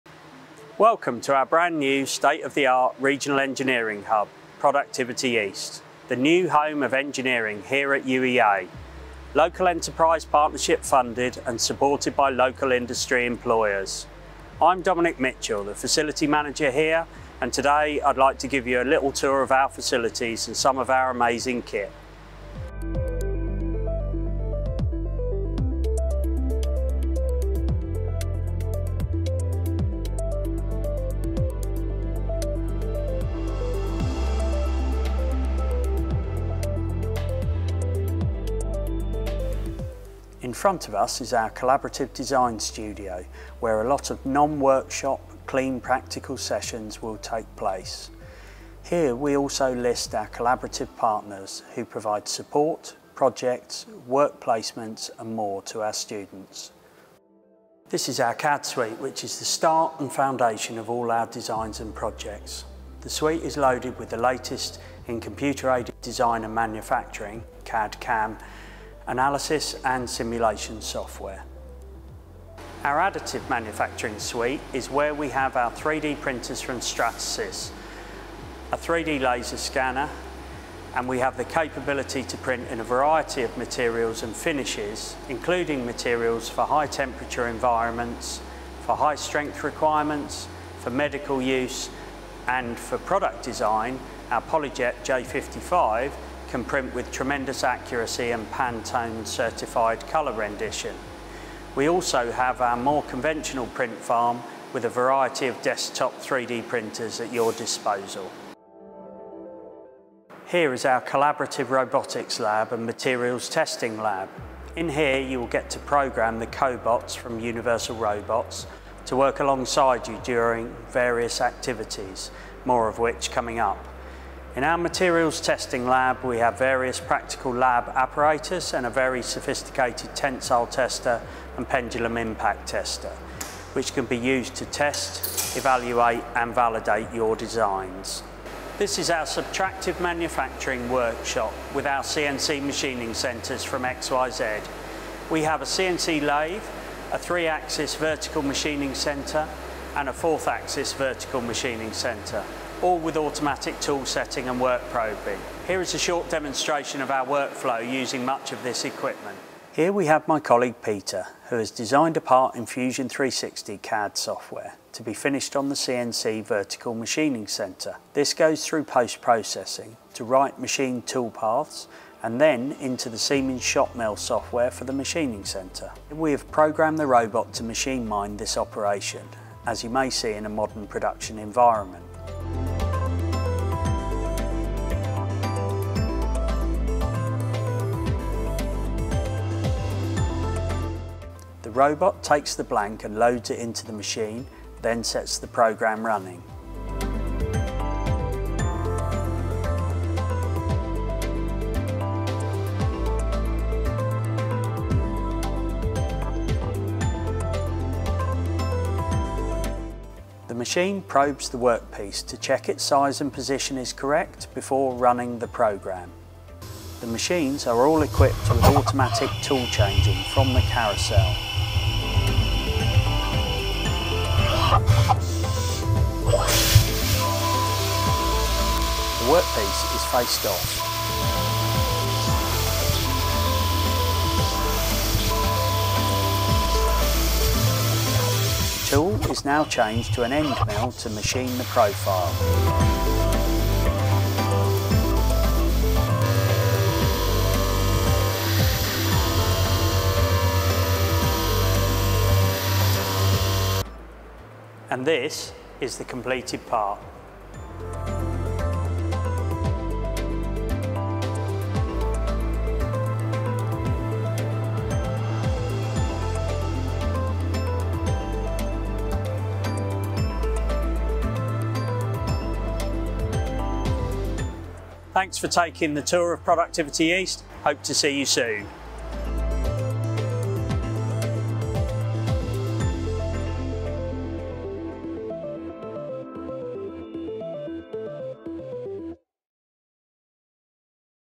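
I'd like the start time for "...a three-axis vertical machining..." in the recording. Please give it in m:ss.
2:27.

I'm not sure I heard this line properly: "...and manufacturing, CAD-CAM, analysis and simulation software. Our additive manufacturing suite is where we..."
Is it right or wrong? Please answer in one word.
right.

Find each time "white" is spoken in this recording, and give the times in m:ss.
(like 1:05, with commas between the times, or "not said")
not said.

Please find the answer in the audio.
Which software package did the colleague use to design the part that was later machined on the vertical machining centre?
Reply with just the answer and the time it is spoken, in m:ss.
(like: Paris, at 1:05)
Fusion 360, at 2:42.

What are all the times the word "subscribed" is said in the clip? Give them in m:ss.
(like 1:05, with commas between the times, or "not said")
not said.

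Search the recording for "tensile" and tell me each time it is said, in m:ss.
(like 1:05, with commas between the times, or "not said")
2:10.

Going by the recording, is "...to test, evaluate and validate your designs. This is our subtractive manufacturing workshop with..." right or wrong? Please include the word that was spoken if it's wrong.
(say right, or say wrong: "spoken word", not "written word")
right.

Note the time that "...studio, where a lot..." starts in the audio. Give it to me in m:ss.
0:42.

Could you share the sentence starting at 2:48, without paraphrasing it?
This goes through post-processing to write machine tool paths, and then into the Siemens ShopMill software for the machining centre.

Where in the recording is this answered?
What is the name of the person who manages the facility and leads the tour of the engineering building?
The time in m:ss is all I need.
0:14.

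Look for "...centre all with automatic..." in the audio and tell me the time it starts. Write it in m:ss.
2:31.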